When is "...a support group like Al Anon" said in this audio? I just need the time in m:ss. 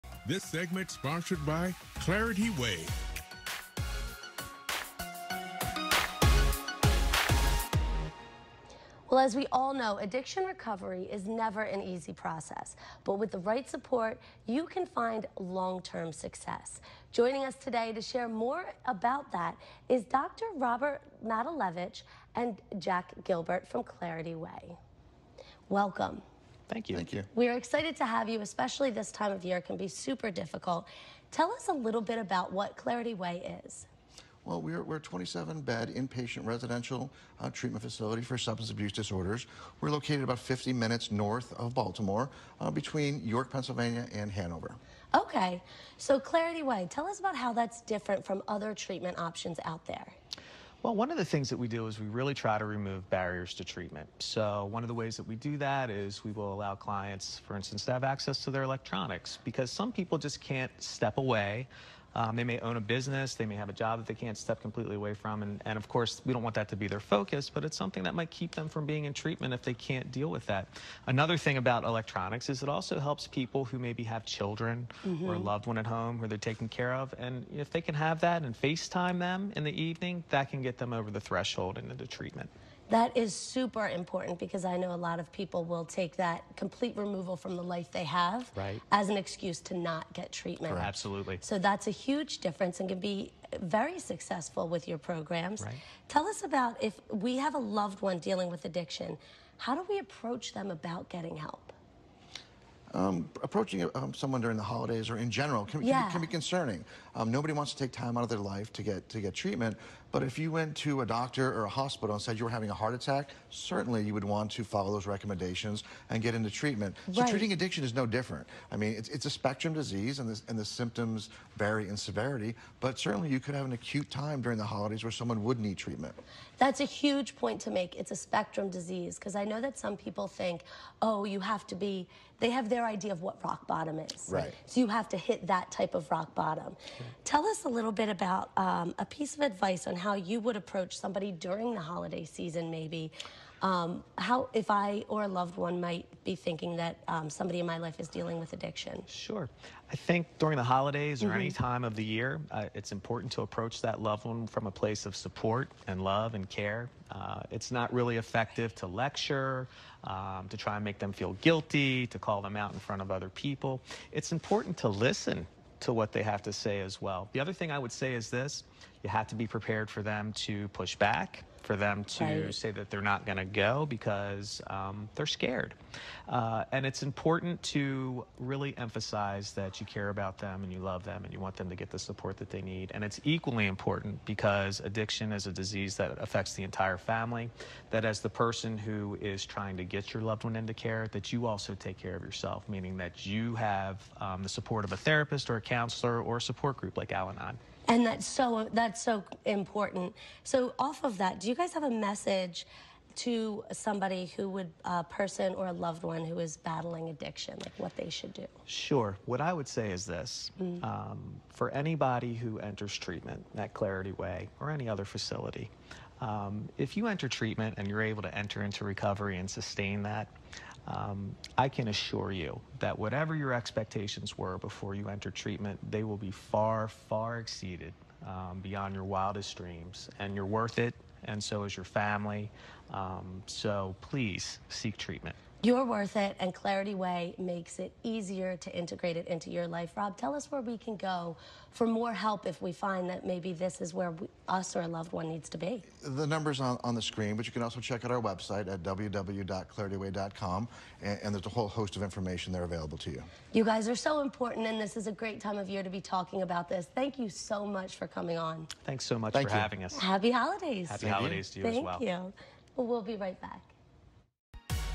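3:16.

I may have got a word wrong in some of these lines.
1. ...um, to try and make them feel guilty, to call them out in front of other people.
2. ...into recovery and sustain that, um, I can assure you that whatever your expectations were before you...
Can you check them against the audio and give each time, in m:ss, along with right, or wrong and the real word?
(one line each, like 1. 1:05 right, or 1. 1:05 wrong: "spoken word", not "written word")
1. 2:40 right
2. 3:38 right.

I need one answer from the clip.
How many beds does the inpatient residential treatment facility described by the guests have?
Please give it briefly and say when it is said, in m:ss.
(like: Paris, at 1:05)
27, at 0:35.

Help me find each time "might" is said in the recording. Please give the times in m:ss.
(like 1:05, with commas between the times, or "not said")
1:08, 2:25.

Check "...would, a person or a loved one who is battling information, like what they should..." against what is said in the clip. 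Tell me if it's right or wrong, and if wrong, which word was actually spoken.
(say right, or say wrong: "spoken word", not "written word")
wrong: "addiction", not "information".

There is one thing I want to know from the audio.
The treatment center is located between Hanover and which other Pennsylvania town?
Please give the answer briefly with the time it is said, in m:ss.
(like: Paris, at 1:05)
York, at 0:43.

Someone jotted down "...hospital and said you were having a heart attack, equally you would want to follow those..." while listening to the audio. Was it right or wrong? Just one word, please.
wrong.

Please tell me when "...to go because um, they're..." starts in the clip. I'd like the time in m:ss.
2:53.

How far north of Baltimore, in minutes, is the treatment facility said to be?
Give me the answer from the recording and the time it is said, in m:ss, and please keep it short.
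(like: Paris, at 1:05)
50 minutes, at 0:40.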